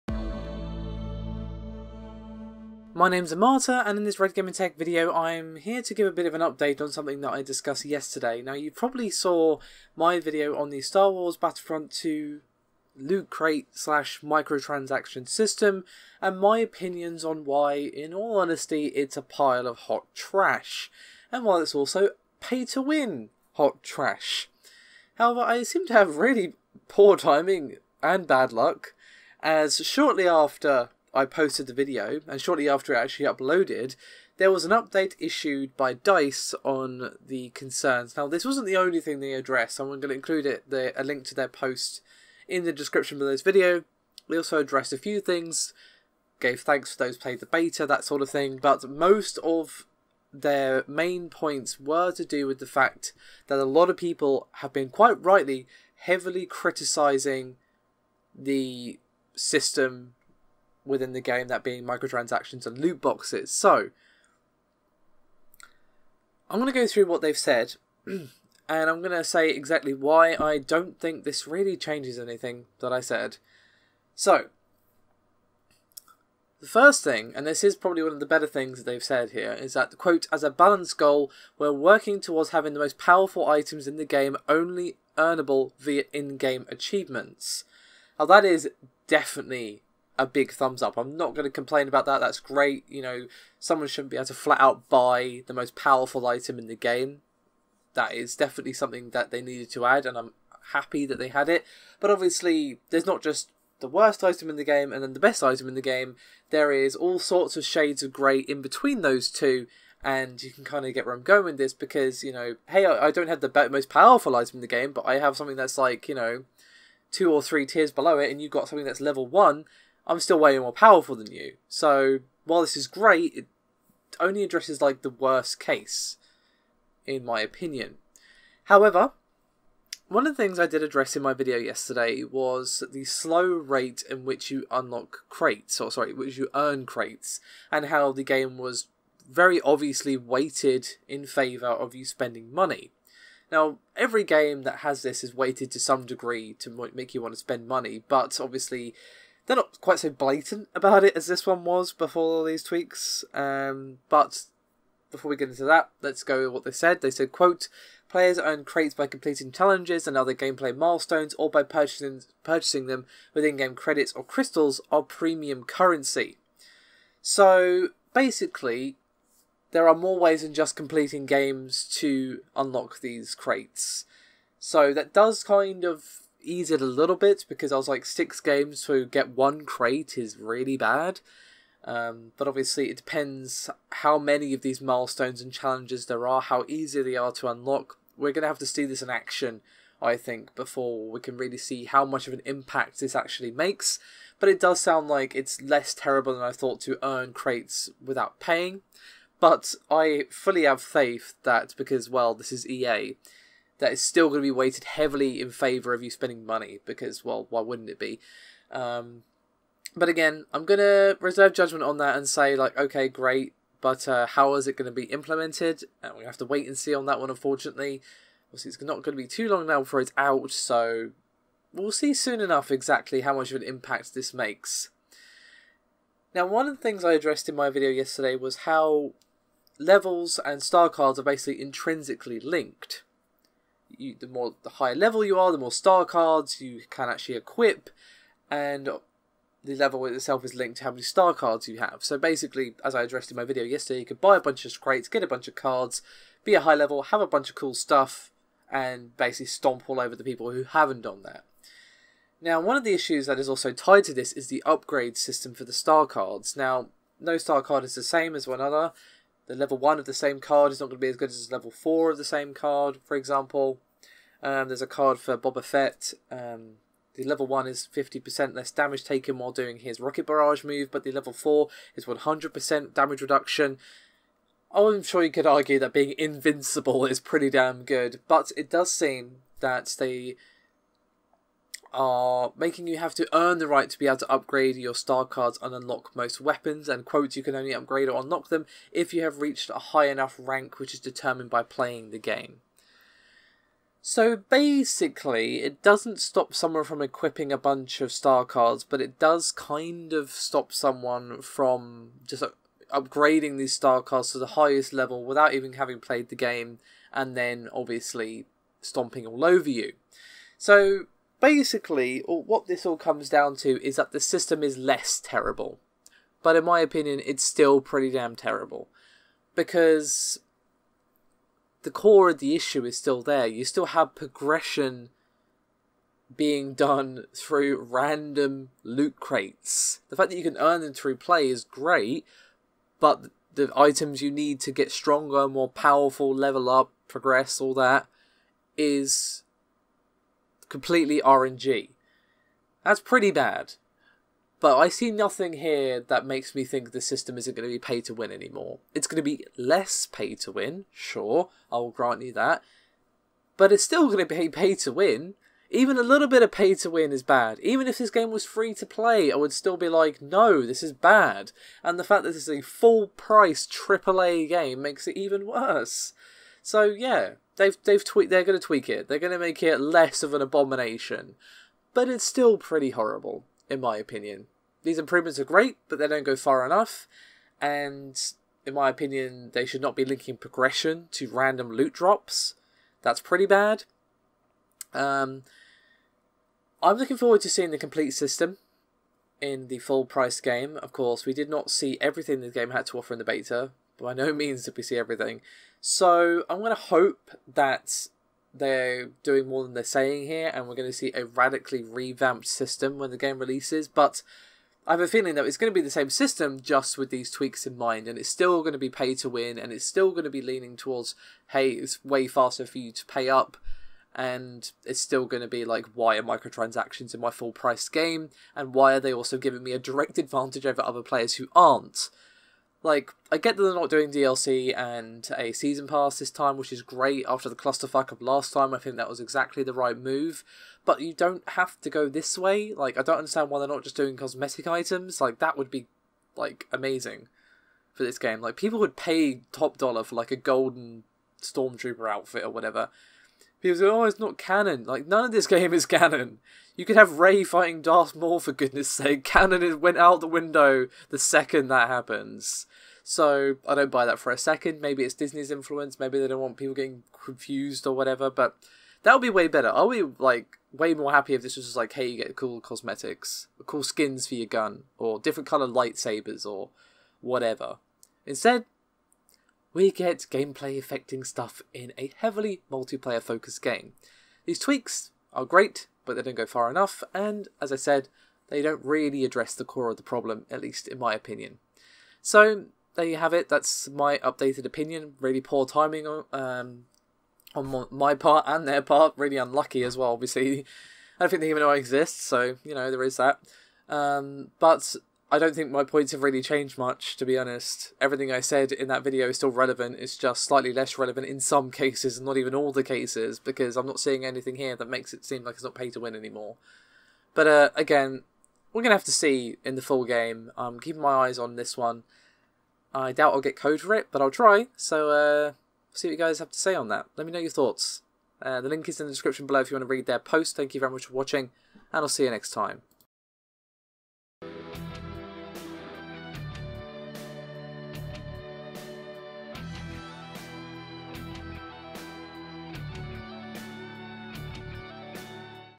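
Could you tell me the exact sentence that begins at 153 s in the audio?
Um, but before we get into that, let's go with what they said.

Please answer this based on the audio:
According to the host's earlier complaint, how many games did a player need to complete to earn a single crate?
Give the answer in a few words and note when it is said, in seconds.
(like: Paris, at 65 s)
6, at 178 s.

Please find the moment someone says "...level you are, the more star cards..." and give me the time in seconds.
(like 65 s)
234 s.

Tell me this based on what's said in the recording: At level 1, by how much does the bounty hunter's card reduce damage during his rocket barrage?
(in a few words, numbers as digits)
50%.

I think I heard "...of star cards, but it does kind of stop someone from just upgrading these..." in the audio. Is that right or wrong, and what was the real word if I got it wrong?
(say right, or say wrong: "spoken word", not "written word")
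right.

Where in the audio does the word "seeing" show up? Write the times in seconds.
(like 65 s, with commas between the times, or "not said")
387 s, 504 s.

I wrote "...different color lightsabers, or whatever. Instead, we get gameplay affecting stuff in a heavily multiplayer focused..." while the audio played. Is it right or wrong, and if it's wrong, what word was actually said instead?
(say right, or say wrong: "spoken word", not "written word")
right.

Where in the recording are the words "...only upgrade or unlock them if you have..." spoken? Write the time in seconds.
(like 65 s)
287 s.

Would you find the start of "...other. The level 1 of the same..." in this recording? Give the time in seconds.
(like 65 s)
258 s.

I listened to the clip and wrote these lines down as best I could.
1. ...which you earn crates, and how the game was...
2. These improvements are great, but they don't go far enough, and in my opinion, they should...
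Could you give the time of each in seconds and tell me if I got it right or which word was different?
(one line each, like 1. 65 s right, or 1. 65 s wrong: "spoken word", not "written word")
1. 136 s right
2. 374 s right.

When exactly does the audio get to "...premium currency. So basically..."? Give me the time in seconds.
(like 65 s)
165 s.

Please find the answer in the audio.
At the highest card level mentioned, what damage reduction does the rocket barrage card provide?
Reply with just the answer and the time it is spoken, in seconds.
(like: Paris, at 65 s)
100%, at 272 s.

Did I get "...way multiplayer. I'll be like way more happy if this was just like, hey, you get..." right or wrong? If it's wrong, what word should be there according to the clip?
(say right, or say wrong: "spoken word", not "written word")
wrong: "better", not "multiplayer".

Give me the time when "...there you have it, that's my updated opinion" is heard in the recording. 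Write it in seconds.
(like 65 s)
482 s.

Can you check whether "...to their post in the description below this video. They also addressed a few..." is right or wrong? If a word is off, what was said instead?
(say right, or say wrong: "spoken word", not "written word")
right.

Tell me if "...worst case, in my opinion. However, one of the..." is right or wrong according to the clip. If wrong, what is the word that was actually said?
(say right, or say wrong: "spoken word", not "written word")
right.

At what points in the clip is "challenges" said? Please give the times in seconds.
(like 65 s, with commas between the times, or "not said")
159 s, 185 s.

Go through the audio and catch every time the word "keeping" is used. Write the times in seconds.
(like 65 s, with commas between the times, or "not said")
510 s.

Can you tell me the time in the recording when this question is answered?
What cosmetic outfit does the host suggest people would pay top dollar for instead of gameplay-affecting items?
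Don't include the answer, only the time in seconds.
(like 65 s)
440 s.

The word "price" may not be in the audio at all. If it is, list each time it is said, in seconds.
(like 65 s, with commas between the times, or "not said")
363 s, 390 s, 417 s.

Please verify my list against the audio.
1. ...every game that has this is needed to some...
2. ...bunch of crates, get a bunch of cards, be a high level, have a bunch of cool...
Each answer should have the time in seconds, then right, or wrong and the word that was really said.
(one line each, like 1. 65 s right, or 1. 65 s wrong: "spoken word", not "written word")
1. 143 s wrong: "weighted", not "needed"
2. 244 s right.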